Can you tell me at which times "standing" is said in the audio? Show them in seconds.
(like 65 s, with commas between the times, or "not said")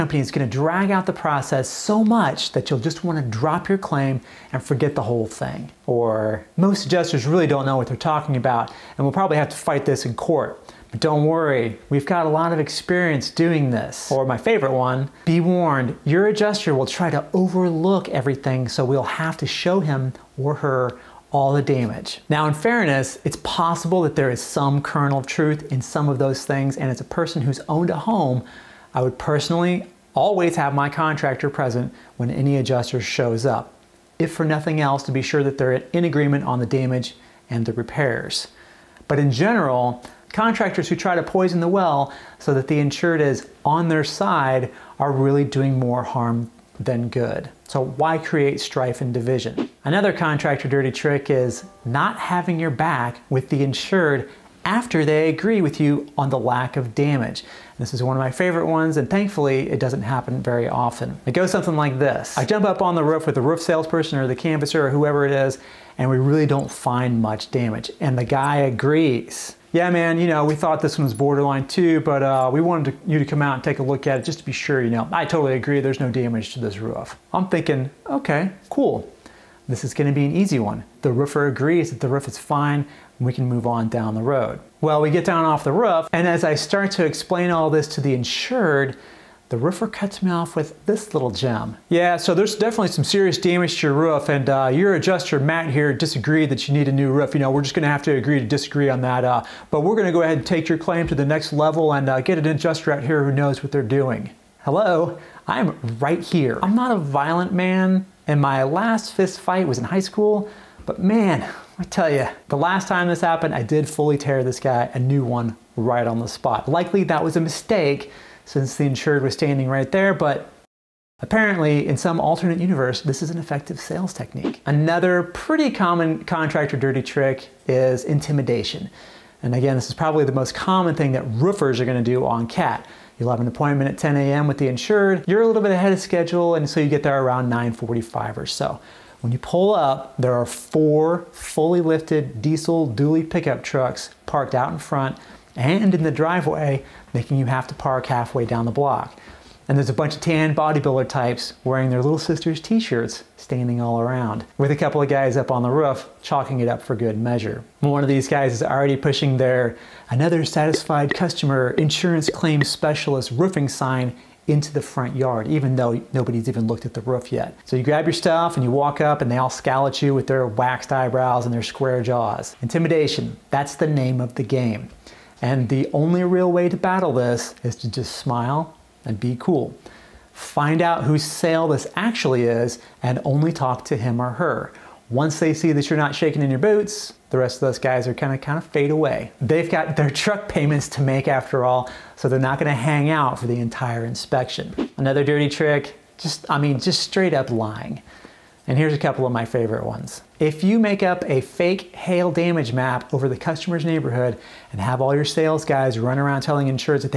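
119 s, 153 s.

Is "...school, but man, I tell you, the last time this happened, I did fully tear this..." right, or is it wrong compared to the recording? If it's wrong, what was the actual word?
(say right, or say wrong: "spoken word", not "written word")
right.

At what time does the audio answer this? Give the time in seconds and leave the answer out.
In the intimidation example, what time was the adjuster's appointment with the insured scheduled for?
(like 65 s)
133 s.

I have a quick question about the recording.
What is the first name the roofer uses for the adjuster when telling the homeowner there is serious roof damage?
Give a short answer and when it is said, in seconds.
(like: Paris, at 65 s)
Matt, at 95 s.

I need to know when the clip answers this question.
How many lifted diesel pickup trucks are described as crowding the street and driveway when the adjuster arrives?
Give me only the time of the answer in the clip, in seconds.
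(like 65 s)
140 s.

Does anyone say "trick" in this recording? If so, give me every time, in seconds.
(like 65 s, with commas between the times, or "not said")
50 s, 127 s, 195 s.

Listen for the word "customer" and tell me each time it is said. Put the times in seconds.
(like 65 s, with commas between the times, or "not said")
161 s, 203 s.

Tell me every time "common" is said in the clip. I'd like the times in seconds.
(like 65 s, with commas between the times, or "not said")
125 s, 130 s.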